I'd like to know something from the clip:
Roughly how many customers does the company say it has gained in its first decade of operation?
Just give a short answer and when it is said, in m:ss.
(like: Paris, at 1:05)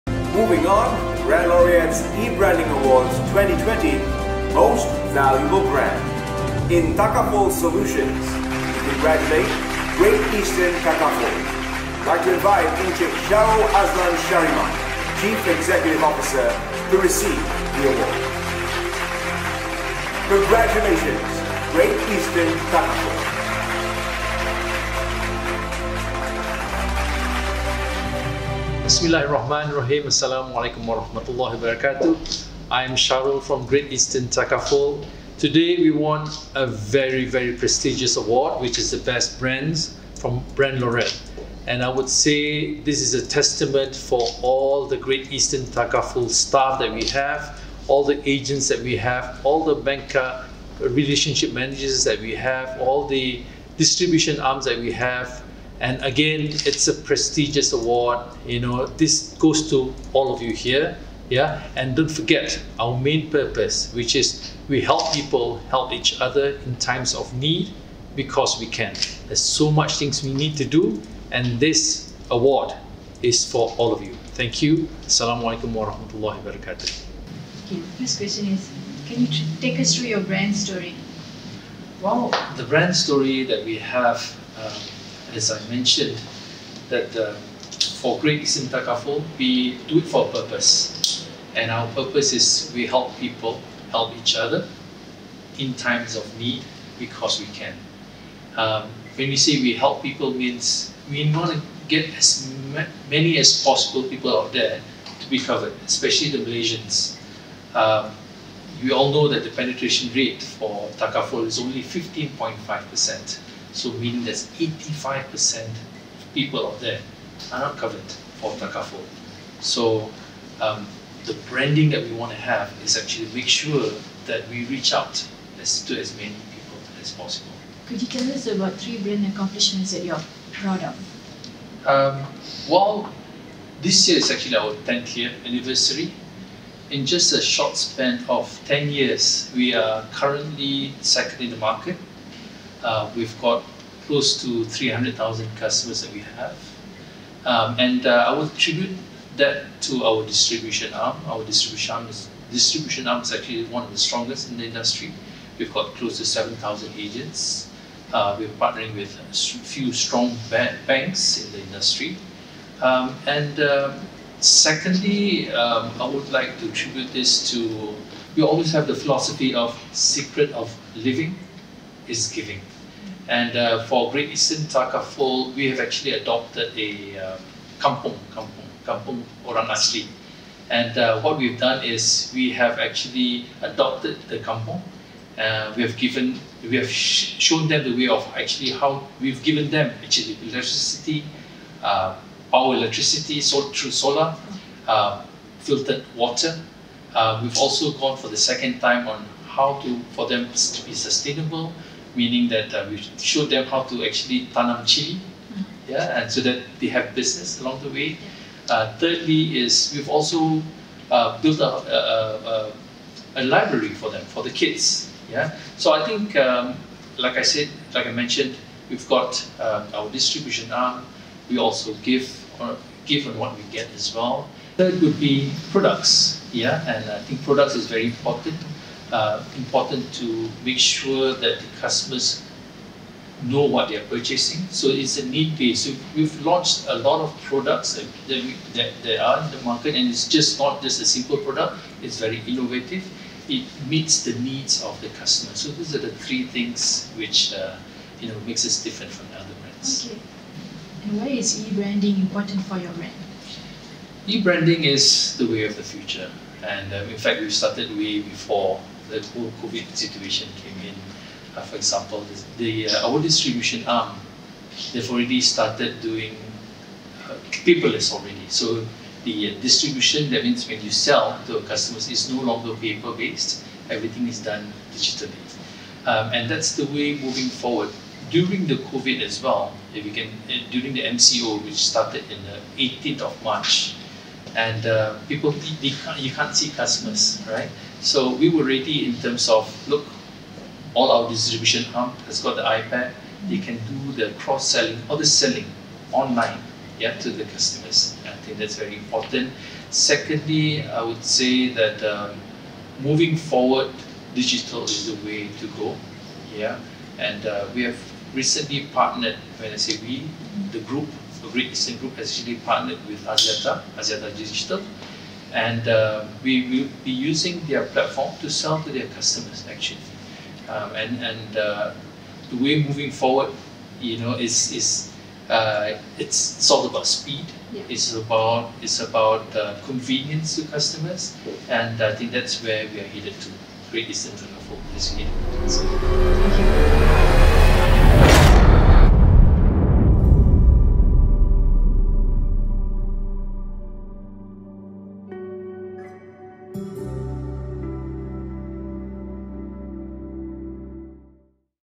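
300,000, at 2:24.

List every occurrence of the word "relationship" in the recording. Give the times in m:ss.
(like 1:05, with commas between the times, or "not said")
0:50.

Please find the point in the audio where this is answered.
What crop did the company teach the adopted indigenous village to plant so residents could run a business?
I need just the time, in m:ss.
3:24.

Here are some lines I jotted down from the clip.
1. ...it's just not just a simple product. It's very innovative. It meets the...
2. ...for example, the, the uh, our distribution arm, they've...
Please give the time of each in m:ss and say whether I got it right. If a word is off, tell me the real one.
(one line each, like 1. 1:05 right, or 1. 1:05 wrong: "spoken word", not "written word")
1. 4:00 right
2. 4:21 right.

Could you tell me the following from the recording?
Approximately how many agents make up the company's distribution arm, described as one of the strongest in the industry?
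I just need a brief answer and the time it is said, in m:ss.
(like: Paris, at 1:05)
7,000, at 2:36.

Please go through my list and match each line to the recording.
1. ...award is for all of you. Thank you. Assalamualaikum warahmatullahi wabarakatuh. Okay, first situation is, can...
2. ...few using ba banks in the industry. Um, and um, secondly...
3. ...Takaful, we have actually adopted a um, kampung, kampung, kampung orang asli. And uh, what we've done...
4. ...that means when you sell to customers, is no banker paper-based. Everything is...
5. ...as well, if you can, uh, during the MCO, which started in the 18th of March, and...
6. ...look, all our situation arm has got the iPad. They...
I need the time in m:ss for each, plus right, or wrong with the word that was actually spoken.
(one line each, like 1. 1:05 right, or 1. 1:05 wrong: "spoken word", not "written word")
1. 1:12 wrong: "question", not "situation"
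2. 2:39 wrong: "strong", not "using"
3. 2:54 right
4. 4:30 wrong: "longer", not "banker"
5. 4:39 right
6. 4:49 wrong: "distribution", not "situation".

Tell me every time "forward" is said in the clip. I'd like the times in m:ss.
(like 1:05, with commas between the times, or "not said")
4:37, 5:03, 5:23.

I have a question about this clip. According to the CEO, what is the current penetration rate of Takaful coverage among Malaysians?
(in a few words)
15.5%.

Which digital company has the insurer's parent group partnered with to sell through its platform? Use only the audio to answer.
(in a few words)
Axiata Digital.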